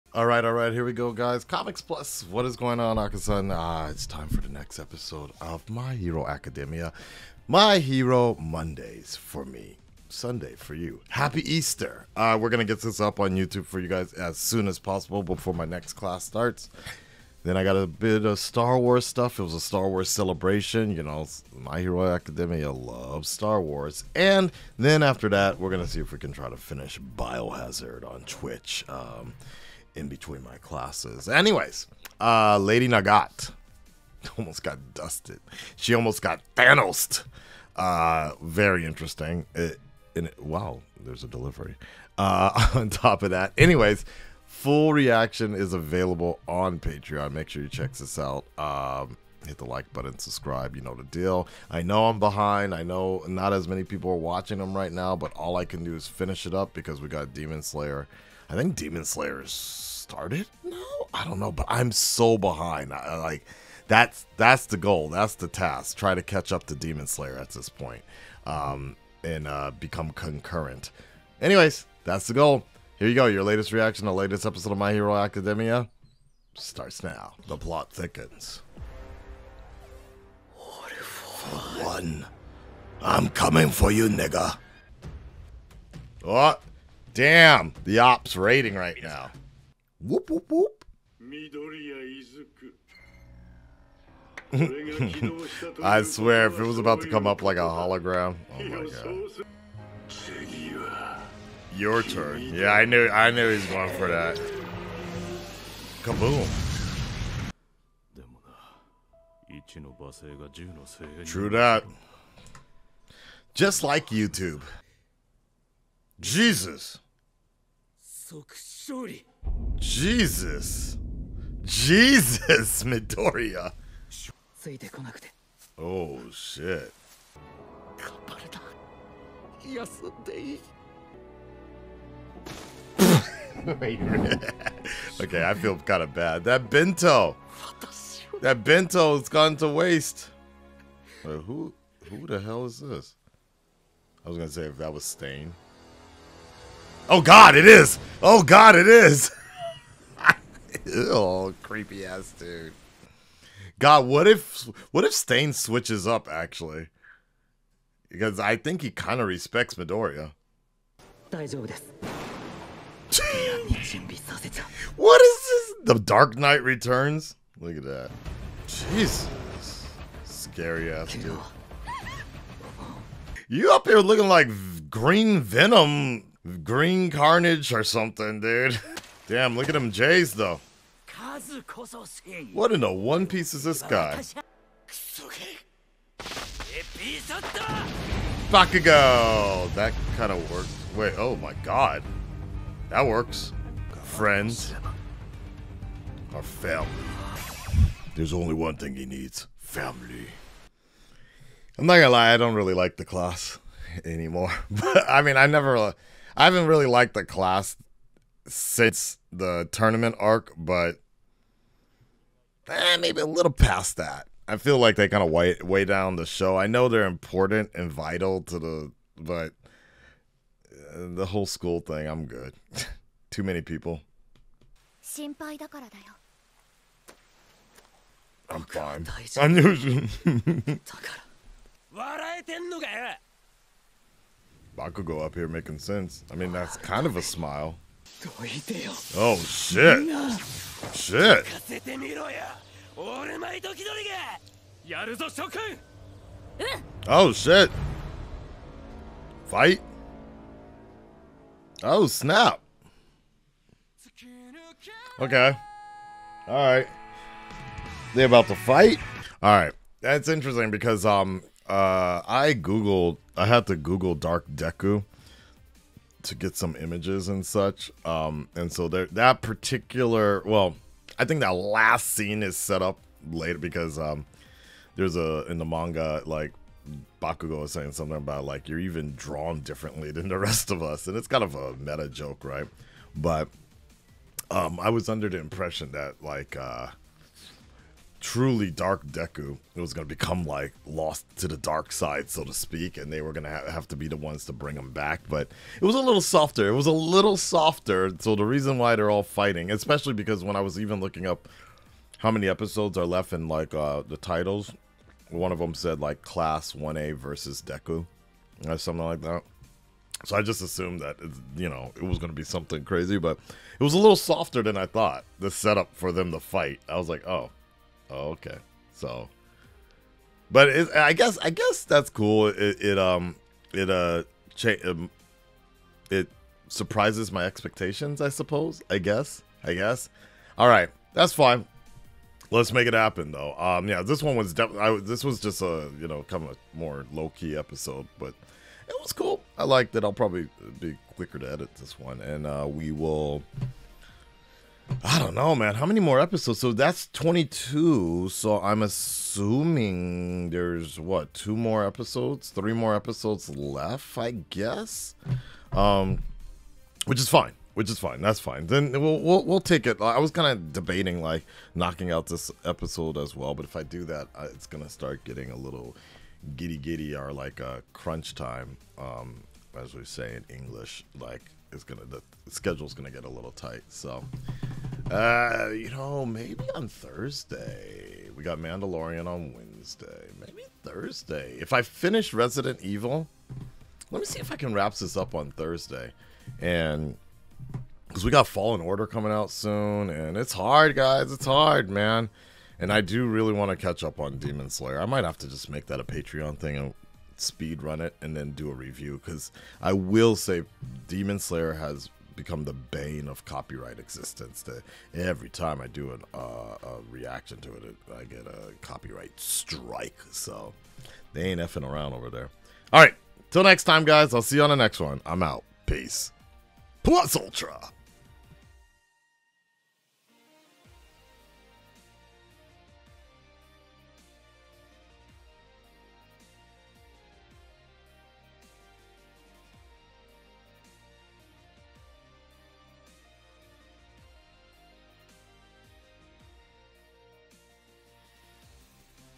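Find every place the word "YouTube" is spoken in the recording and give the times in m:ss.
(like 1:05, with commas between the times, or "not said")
0:13, 1:54.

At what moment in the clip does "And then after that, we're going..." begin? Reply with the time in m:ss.
0:24.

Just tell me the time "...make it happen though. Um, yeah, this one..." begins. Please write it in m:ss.
5:32.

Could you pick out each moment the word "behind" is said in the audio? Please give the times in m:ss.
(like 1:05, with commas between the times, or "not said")
0:52, 1:02.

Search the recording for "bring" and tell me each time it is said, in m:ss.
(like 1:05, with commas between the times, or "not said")
4:54.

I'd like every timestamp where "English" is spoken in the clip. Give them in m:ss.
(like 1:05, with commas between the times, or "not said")
6:10.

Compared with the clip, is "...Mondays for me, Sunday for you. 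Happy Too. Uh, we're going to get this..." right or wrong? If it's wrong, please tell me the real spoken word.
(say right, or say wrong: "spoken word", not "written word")
wrong: "Easter", not "Too".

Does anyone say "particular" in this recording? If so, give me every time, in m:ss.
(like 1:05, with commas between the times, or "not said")
4:29.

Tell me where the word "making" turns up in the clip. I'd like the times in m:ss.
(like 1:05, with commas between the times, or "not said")
3:55.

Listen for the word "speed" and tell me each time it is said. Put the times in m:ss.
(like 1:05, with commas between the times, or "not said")
6:37.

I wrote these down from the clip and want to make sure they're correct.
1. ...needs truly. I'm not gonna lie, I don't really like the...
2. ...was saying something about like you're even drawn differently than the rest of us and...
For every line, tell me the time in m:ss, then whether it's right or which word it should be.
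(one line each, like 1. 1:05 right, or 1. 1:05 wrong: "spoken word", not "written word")
1. 3:19 wrong: "family", not "truly"
2. 4:37 right.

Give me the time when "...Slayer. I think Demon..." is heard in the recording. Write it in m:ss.
0:57.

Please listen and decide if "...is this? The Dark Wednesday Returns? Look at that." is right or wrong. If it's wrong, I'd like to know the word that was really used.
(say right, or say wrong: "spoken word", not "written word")
wrong: "Knight", not "Wednesday".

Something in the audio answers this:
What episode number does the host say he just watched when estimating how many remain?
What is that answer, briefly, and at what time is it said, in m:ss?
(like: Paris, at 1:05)
22, at 5:47.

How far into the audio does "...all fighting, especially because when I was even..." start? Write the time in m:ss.
4:59.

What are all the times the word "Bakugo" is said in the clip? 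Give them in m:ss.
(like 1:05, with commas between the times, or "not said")
3:08, 3:54, 4:37.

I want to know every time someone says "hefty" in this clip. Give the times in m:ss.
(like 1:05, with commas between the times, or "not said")
not said.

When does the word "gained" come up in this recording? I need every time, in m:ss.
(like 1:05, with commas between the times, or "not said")
not said.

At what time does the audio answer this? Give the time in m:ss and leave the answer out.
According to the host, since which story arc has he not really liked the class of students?
3:29.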